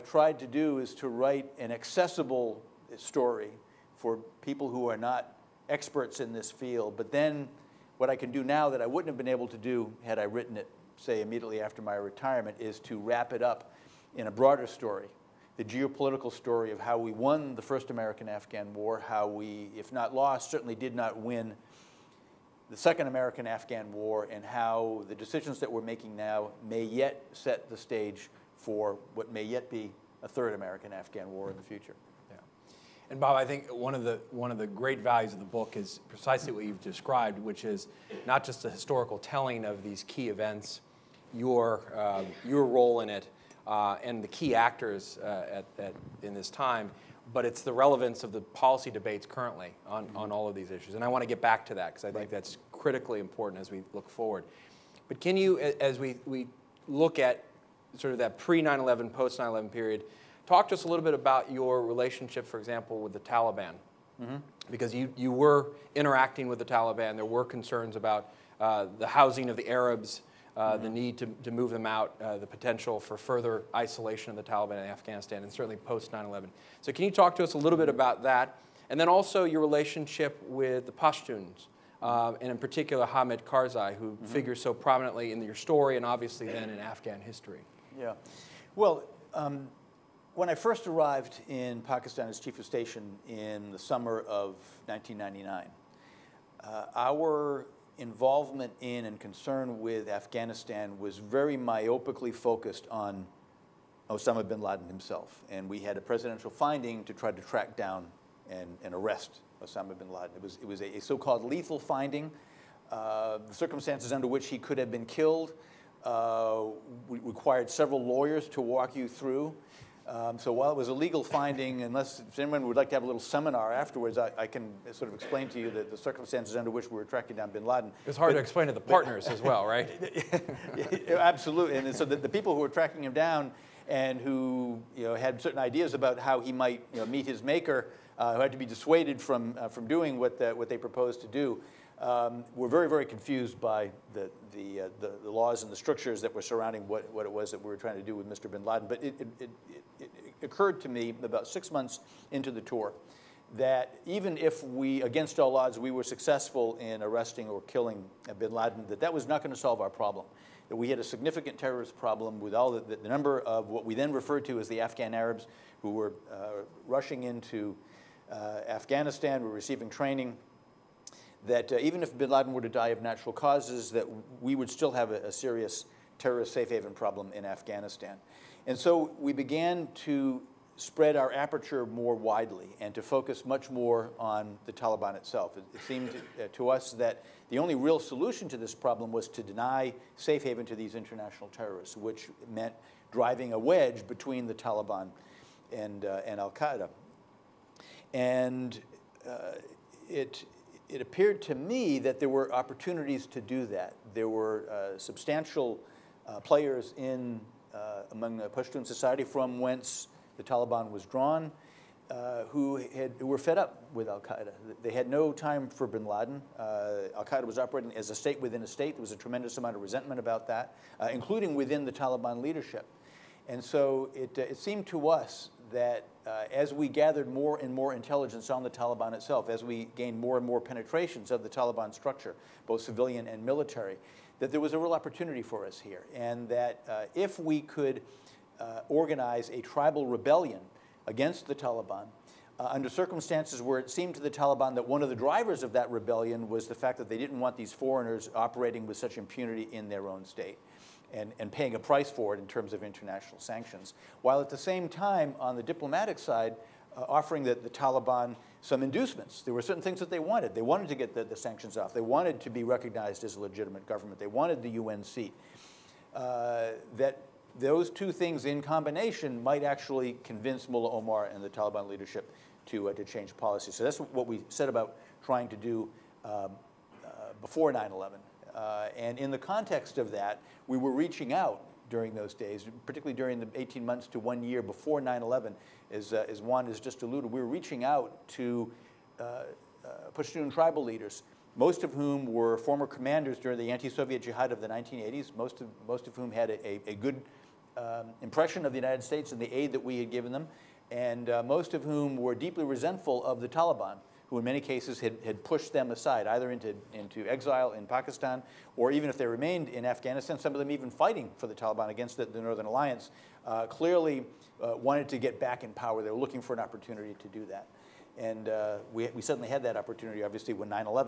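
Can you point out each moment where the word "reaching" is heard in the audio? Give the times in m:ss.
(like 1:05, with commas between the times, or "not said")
4:40, 4:47.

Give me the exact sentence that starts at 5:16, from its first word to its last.
They were looking for an opportunity to do that.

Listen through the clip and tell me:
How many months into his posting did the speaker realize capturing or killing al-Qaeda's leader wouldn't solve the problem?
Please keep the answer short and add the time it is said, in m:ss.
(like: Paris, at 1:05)
6, at 2:31.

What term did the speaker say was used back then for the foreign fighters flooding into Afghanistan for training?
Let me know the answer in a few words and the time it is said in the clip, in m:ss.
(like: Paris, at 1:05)
Afghan Arabs, at 2:44.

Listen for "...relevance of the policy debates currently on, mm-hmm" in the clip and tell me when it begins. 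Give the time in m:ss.
0:47.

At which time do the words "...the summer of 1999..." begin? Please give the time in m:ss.
1:33.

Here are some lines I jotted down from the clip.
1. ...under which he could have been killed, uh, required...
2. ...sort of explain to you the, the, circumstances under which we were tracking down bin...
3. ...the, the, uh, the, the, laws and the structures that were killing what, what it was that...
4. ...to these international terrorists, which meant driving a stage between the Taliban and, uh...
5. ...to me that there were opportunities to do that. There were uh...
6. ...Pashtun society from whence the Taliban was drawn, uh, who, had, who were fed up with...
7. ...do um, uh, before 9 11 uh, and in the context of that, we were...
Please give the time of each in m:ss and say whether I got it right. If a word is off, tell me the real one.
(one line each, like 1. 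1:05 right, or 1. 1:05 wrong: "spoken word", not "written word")
1. 1:54 right
2. 2:04 right
3. 2:24 wrong: "surrounding", not "killing"
4. 3:10 wrong: "wedge", not "stage"
5. 3:21 right
6. 3:28 right
7. 4:35 right.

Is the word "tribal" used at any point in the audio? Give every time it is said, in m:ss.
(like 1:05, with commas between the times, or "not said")
3:59, 4:50.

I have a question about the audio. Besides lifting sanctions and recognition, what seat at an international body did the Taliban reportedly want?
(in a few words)
The UN seat.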